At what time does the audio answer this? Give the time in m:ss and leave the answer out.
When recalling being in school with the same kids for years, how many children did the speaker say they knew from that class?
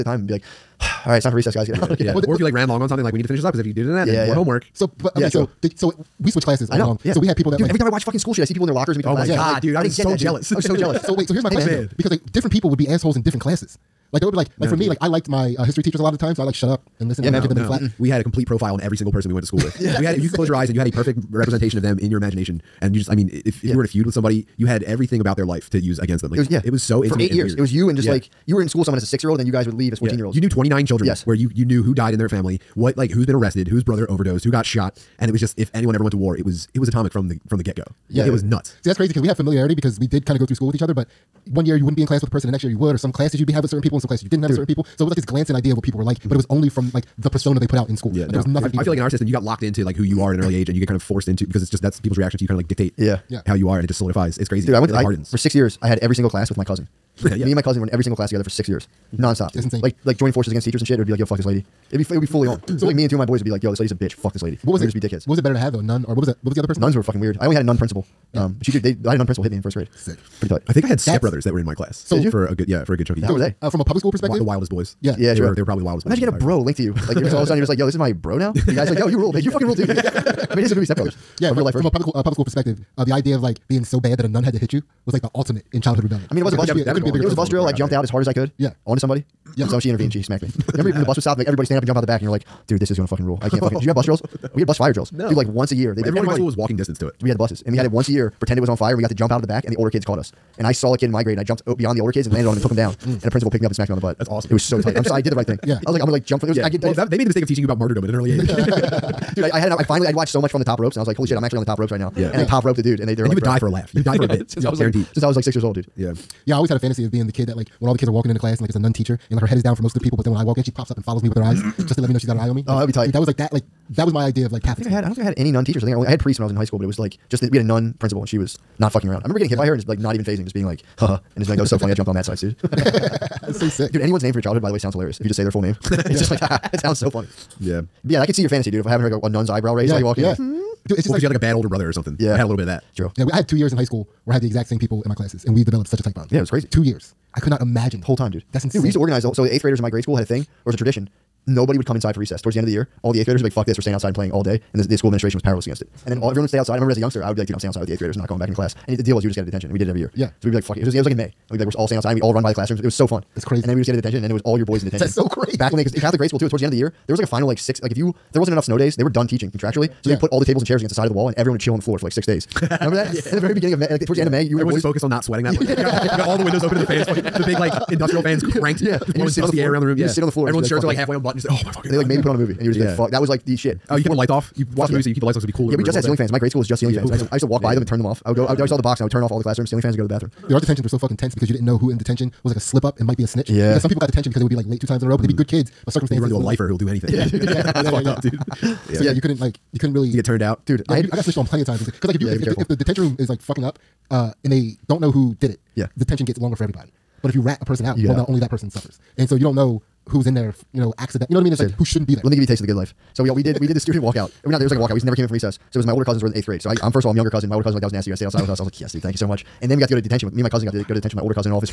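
0:30.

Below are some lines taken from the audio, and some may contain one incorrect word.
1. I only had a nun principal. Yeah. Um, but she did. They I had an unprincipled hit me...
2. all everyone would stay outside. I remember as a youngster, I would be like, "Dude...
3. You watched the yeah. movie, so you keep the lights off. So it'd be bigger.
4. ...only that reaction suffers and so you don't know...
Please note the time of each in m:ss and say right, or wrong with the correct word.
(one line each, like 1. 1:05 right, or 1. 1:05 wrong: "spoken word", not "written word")
1. 1:07 right
2. 2:36 right
3. 3:04 wrong: "cooler", not "bigger"
4. 3:28 wrong: "person", not "reaction".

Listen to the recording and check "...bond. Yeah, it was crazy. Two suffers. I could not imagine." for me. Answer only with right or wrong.
wrong.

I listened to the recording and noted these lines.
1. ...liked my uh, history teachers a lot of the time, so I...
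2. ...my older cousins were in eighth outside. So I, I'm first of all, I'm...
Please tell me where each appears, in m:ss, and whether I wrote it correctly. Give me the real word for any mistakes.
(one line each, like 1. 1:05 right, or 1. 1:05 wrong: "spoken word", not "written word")
1. 0:15 right
2. 3:35 wrong: "grade", not "outside".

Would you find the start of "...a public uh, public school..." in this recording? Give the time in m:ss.
1:21.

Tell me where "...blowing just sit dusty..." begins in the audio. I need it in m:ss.
2:59.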